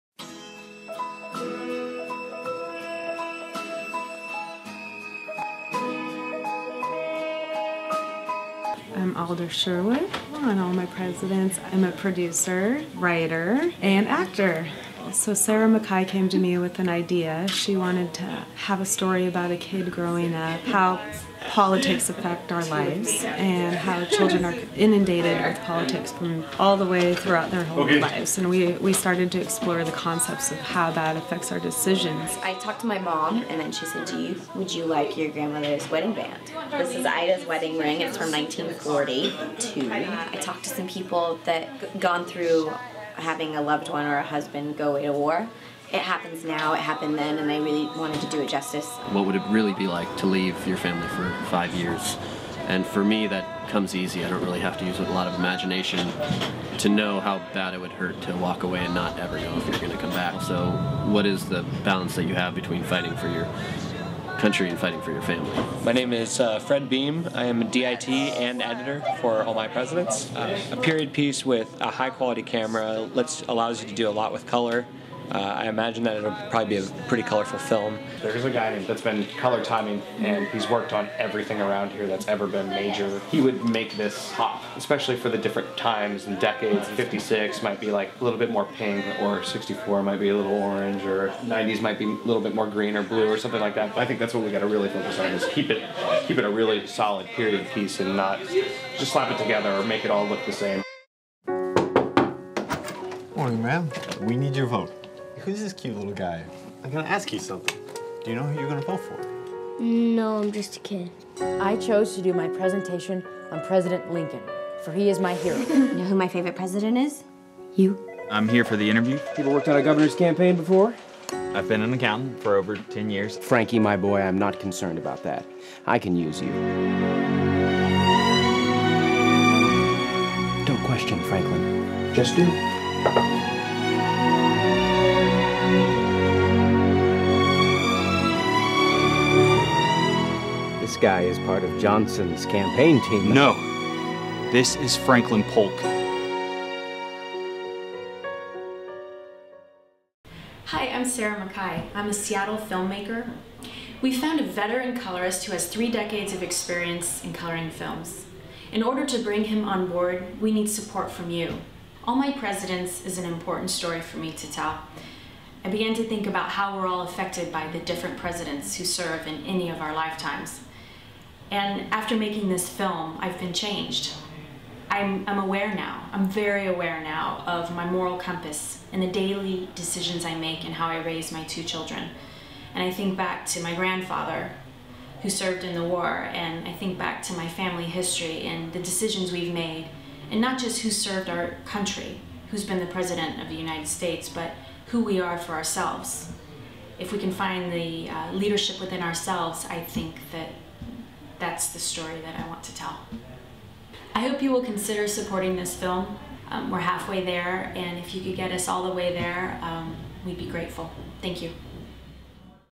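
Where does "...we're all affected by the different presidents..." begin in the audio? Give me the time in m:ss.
2:46.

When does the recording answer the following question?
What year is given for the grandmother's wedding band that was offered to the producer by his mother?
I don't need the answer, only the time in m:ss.
0:38.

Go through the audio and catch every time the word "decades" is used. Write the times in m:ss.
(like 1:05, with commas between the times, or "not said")
1:26, 2:35.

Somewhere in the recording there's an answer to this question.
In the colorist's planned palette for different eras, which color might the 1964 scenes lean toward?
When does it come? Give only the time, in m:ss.
1:30.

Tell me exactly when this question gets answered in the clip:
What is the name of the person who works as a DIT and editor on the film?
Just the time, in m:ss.
1:06.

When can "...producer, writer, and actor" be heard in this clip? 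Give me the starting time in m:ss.
0:11.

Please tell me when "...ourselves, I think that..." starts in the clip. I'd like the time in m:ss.
3:19.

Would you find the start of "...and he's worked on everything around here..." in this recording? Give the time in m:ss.
1:20.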